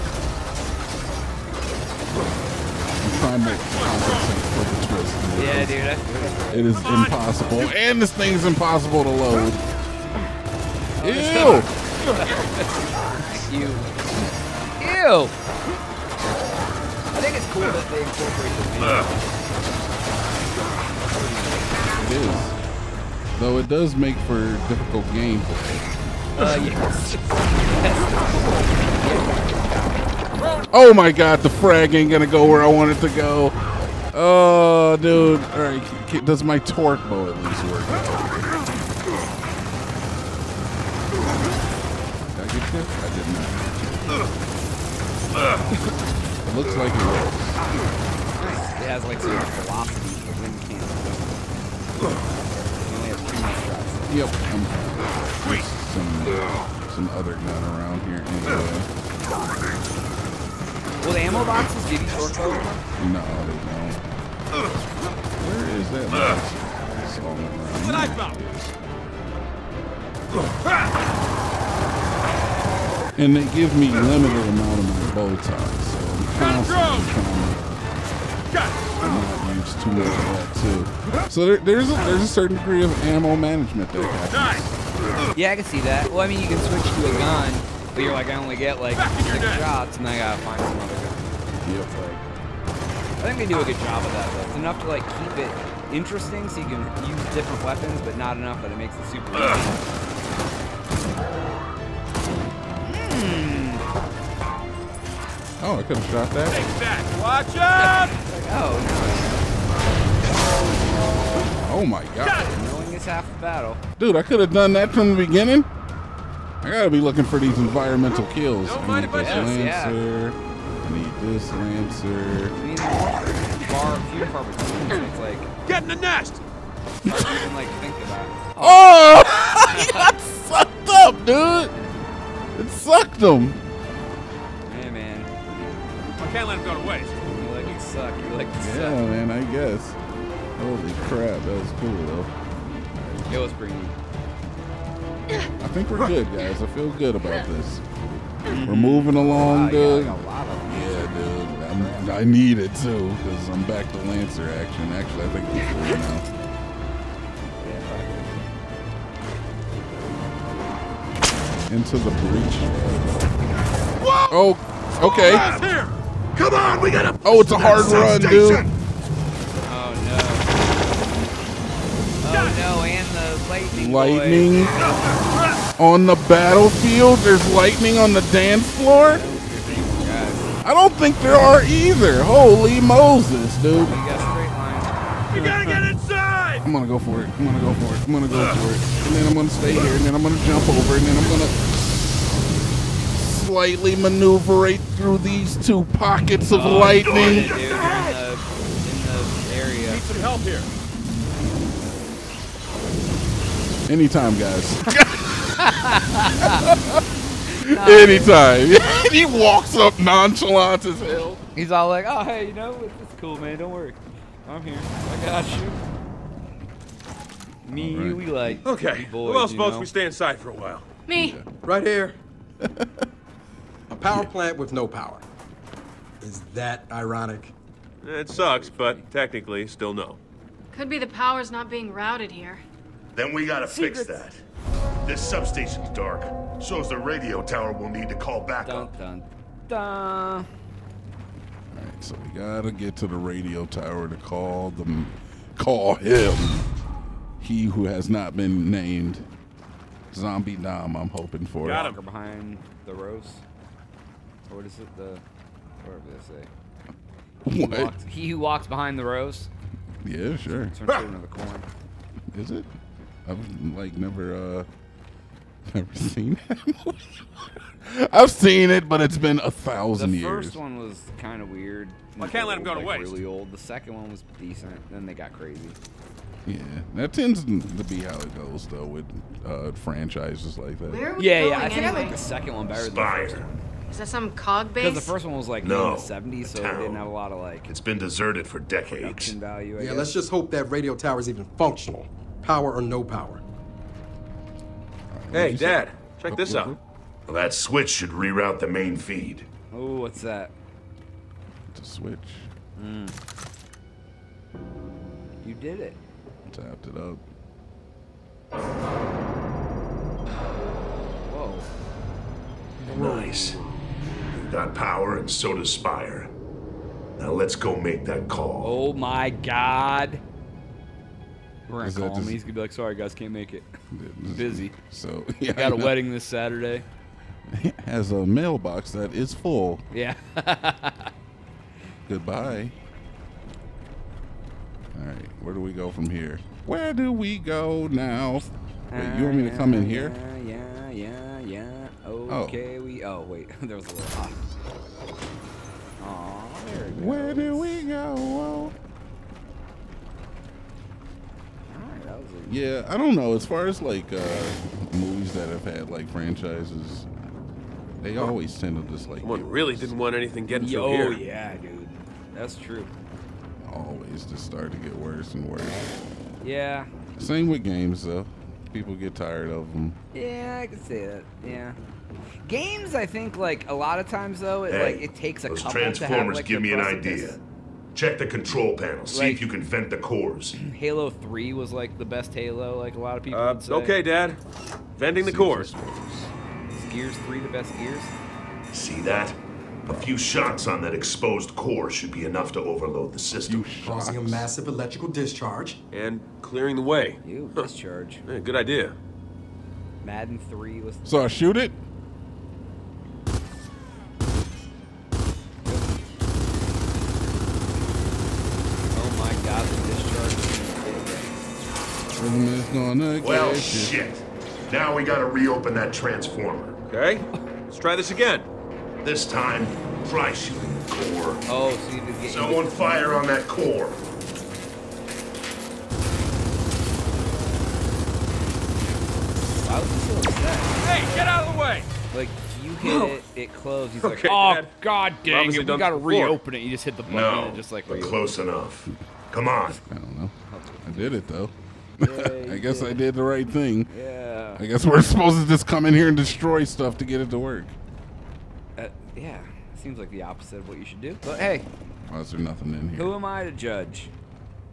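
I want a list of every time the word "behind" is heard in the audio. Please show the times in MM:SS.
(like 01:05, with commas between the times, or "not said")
04:12, 04:18.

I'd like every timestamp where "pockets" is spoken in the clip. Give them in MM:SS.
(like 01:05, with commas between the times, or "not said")
03:15.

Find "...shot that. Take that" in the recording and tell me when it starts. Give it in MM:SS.
01:46.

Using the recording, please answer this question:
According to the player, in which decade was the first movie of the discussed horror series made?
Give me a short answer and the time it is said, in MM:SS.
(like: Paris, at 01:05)
The 70s, at 04:45.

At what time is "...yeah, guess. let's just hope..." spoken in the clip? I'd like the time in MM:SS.
04:49.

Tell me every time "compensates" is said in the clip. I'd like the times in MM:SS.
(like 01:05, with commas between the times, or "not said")
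00:03.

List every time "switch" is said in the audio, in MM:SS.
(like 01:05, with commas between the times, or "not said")
01:26, 04:57, 05:01.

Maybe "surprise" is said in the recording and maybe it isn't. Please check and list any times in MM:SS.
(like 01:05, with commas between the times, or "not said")
not said.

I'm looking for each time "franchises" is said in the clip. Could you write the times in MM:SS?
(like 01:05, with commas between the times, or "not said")
04:39, 05:56.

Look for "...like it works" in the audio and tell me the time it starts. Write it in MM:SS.
00:46.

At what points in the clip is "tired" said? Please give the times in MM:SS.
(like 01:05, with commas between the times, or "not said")
06:09.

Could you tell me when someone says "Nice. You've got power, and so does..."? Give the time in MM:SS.
05:12.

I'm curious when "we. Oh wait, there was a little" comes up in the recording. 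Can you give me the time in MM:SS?
05:42.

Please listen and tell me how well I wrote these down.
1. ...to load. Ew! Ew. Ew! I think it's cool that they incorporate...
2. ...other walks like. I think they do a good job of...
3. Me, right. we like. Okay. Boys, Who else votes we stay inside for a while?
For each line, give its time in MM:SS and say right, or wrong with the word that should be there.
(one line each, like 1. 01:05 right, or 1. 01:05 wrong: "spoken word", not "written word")
1. 00:09 right
2. 01:30 wrong: "looks", not "walks"
3. 03:37 right.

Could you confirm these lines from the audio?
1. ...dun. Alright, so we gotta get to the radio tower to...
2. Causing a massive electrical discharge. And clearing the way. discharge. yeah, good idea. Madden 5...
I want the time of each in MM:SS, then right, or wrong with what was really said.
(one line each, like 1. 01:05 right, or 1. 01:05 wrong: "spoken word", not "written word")
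1. 03:59 right
2. 06:33 wrong: "3", not "5".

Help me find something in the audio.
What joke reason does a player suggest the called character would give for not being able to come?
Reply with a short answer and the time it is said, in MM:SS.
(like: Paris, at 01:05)
A wedding, at 05:25.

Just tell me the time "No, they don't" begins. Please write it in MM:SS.
01:02.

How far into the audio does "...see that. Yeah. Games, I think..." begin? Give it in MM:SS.
06:10.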